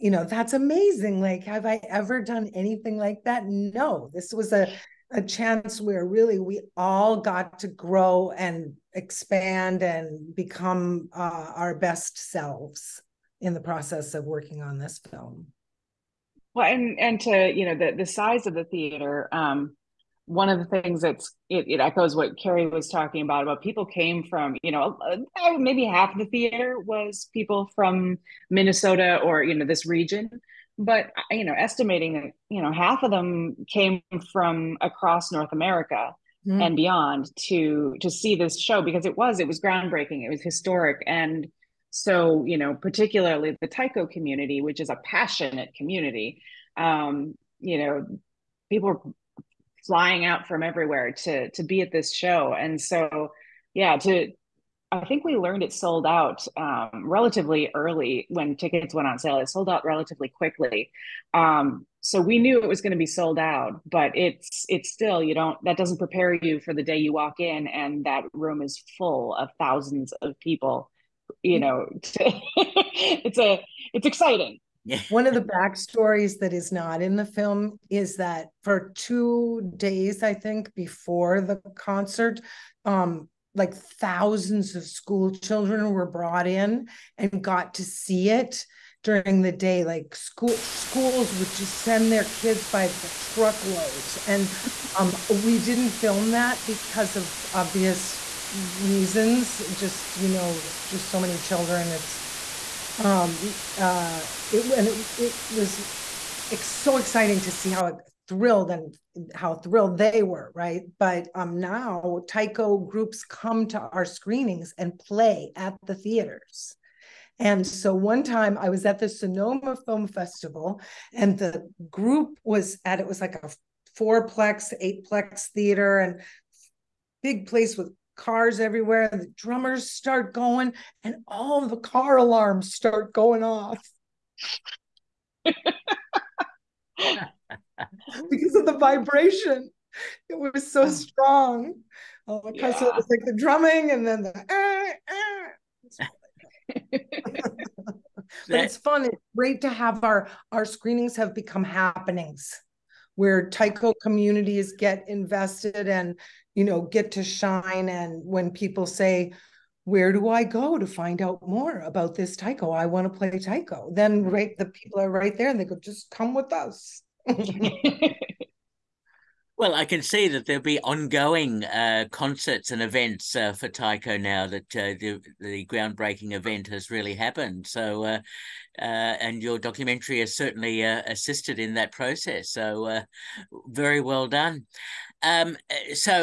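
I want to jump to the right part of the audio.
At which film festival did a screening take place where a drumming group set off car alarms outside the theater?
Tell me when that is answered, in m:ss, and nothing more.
1:59.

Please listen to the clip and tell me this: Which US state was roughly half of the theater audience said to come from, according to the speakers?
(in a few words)
Minnesota.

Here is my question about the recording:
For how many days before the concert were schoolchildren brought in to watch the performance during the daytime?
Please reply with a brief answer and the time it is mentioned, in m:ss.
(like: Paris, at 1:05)
2, at 1:18.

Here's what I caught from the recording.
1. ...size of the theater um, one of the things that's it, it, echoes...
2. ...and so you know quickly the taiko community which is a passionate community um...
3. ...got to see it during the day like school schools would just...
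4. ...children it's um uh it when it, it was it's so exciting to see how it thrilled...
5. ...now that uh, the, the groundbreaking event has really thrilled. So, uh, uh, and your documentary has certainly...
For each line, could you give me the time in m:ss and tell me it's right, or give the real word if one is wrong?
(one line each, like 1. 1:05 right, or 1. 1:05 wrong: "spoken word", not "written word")
1. 0:18 right
2. 0:41 wrong: "particularly", not "quickly"
3. 1:27 right
4. 1:41 right
5. 2:54 wrong: "happened", not "thrilled".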